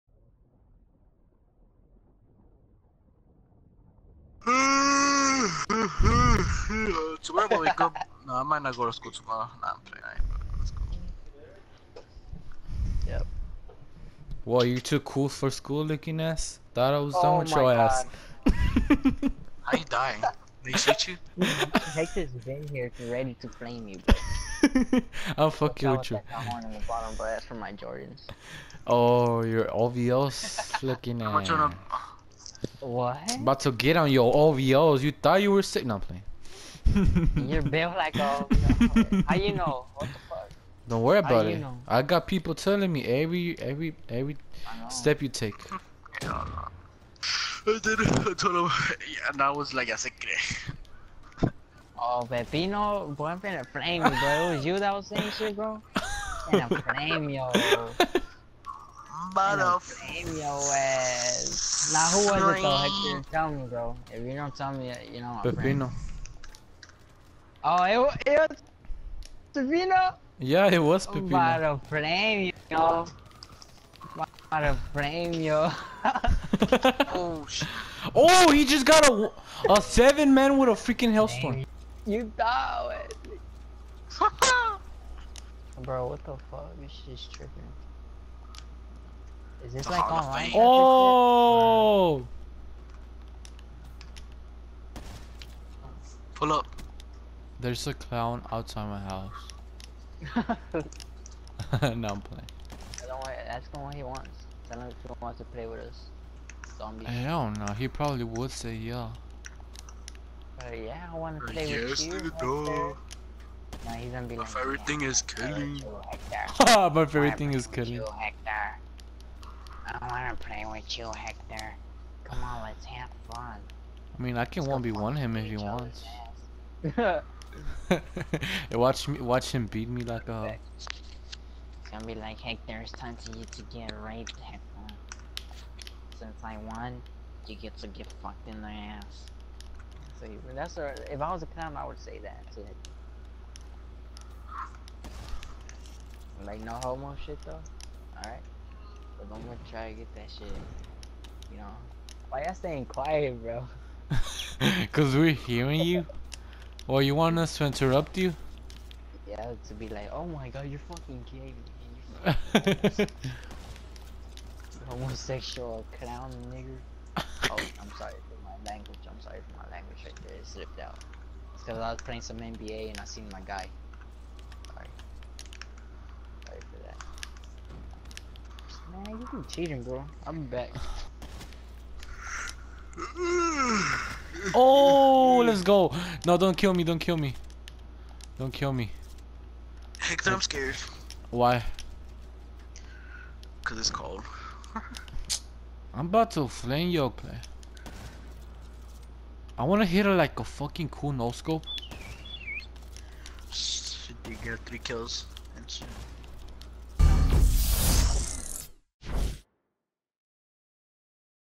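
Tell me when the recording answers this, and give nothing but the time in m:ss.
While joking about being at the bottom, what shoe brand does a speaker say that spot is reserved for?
0:27.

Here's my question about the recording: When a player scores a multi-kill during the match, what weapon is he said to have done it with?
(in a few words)
Hailstorm.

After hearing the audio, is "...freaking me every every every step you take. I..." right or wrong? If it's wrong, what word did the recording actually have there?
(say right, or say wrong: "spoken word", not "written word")
wrong: "telling", not "freaking".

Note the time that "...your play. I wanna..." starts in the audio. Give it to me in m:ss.
3:16.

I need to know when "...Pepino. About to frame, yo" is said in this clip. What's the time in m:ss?
1:11.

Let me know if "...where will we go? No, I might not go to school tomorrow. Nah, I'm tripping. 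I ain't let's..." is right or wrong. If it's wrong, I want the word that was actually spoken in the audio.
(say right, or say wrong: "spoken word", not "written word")
wrong: "playing", not "tripping".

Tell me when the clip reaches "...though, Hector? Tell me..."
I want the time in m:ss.
1:02.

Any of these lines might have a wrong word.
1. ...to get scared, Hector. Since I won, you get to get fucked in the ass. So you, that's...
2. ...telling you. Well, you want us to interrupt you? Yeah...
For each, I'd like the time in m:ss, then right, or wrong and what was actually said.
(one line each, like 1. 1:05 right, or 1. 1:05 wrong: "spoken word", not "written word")
1. 2:13 wrong: "raped", not "scared"
2. 2:35 wrong: "hearing", not "telling".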